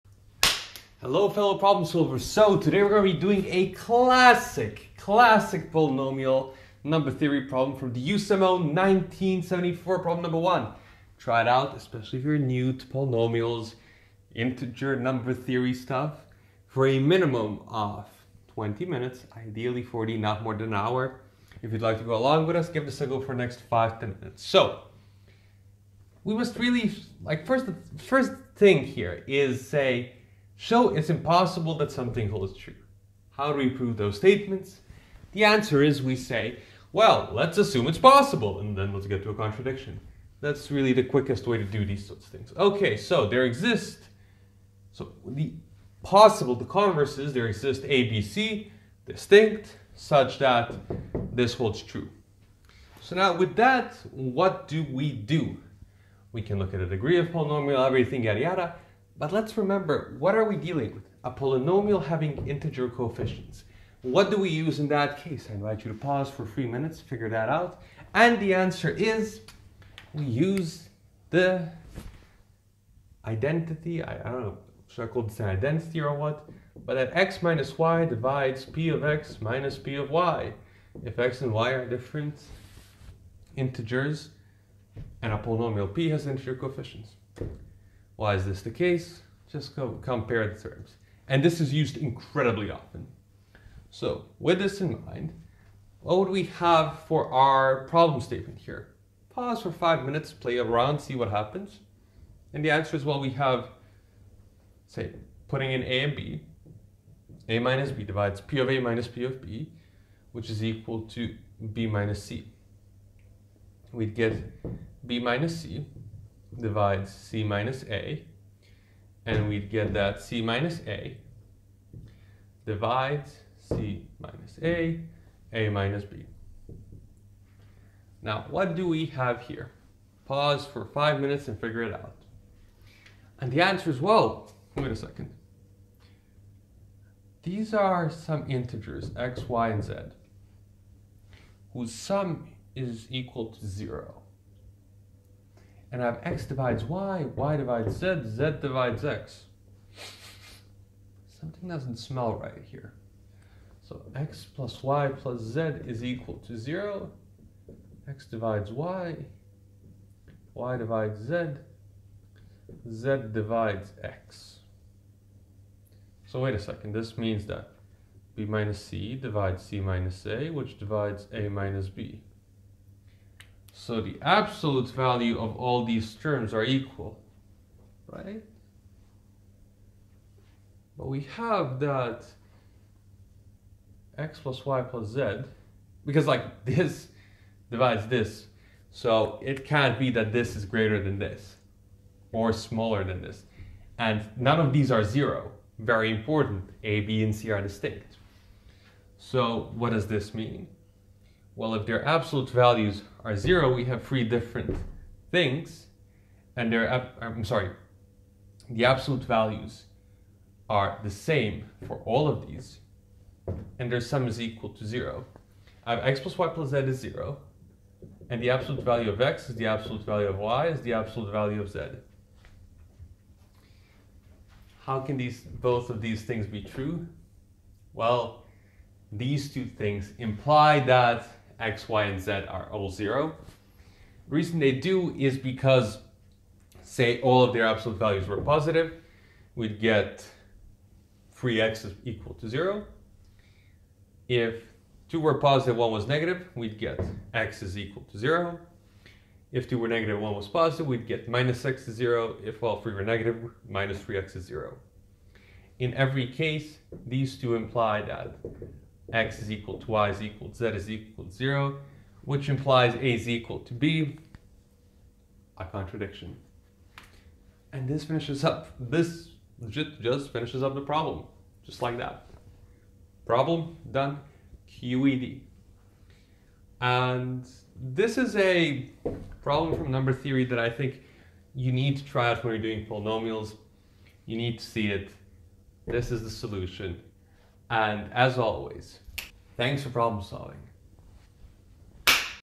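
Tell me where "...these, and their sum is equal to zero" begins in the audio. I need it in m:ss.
3:32.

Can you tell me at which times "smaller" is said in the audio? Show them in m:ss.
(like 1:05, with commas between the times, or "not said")
3:12.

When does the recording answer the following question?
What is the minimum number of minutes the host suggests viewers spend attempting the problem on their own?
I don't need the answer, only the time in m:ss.
0:18.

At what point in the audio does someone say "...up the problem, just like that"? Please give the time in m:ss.
4:30.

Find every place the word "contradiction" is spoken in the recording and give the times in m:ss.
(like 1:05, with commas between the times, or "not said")
0:39, 4:25.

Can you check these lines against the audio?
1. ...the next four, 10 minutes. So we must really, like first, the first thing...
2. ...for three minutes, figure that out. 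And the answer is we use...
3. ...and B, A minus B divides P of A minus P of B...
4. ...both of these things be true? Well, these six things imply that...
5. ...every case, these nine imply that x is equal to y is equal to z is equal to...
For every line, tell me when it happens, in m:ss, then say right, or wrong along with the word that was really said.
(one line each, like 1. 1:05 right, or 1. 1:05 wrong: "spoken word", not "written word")
1. 0:23 wrong: "five", not "four"
2. 1:06 right
3. 1:46 right
4. 3:45 wrong: "two", not "six"
5. 4:15 wrong: "two", not "nine".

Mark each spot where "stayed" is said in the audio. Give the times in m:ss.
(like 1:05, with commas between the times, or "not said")
not said.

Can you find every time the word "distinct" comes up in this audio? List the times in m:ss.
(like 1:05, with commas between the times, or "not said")
0:49, 3:17.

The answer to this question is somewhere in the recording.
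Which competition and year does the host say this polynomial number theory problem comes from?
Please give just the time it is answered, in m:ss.
0:08.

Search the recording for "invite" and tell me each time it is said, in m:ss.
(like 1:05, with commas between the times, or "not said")
1:05.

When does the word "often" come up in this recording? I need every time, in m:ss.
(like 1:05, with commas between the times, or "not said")
1:32.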